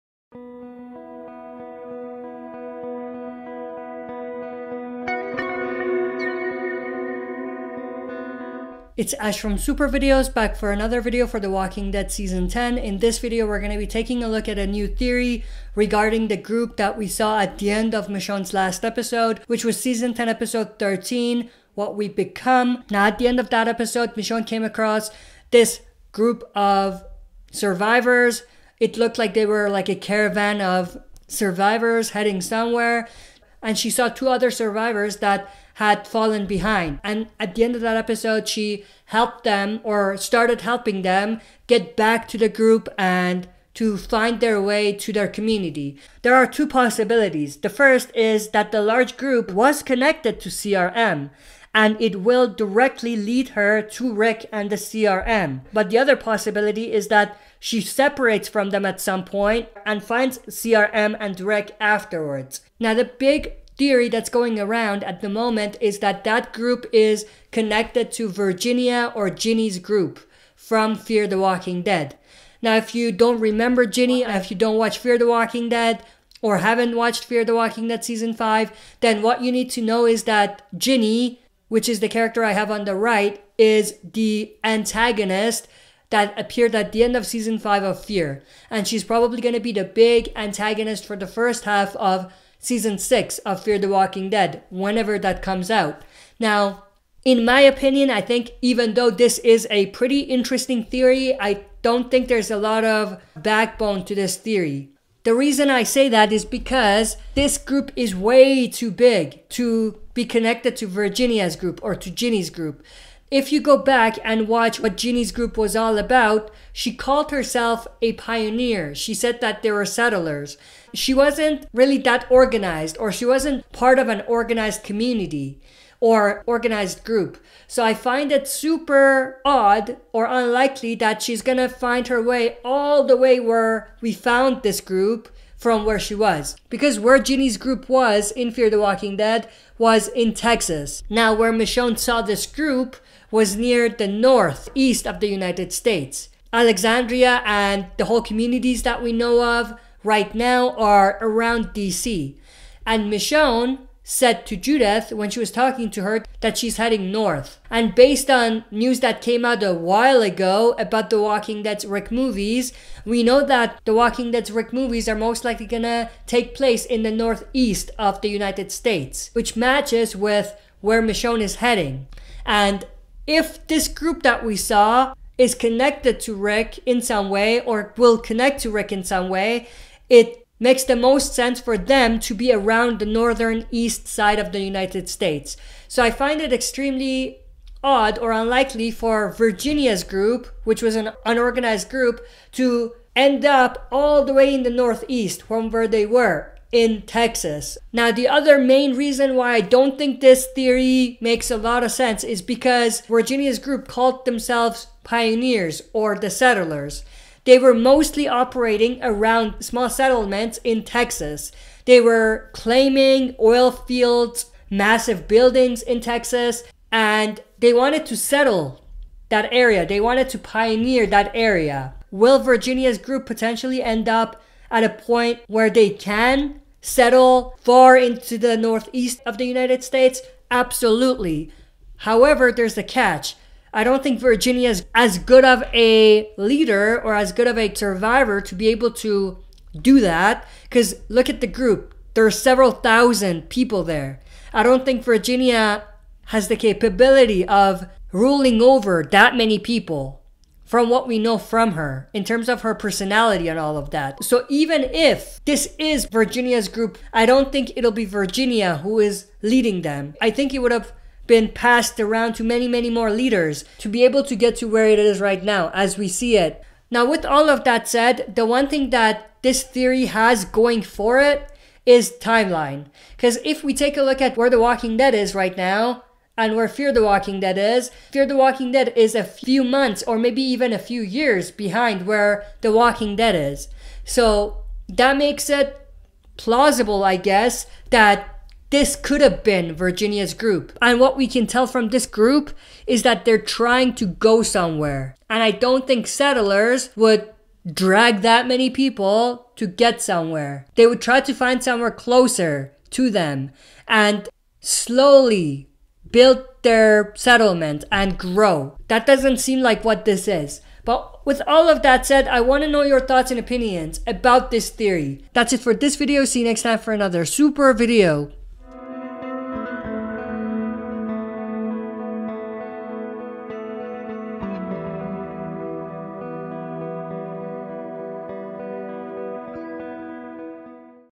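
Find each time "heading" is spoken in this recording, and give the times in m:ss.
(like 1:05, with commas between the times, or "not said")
0:32, 2:36, 2:51.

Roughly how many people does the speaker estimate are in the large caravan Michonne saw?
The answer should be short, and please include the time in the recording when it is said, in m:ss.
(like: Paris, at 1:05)
Several thousand, at 4:02.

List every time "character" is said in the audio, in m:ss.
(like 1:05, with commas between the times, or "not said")
1:22.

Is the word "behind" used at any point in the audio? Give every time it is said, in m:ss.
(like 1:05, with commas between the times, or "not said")
0:36, 4:41.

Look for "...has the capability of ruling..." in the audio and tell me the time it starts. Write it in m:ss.
4:06.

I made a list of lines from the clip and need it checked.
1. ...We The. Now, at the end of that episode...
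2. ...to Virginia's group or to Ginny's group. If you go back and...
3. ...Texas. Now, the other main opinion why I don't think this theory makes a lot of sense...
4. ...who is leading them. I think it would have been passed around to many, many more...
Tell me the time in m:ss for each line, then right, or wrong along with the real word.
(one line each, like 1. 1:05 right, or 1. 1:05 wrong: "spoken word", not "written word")
1. 0:21 wrong: "Become", not "The"
2. 1:50 right
3. 3:17 wrong: "reason", not "opinion"
4. 4:18 right.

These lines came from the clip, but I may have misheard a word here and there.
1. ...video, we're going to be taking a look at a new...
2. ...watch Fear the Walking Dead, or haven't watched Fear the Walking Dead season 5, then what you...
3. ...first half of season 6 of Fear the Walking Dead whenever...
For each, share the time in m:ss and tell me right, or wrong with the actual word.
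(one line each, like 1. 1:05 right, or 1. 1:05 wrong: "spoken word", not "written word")
1. 0:13 right
2. 1:14 right
3. 1:31 right.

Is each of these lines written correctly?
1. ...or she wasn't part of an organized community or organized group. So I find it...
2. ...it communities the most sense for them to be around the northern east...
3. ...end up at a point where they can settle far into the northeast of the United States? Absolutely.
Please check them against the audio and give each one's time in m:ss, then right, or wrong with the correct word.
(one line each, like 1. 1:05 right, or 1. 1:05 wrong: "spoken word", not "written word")
1. 2:02 right
2. 3:00 wrong: "makes", not "communities"
3. 3:43 right.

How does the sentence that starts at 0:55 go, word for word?
But the other possibility is that she separates from them at some point and finds CRM and Rick afterwards.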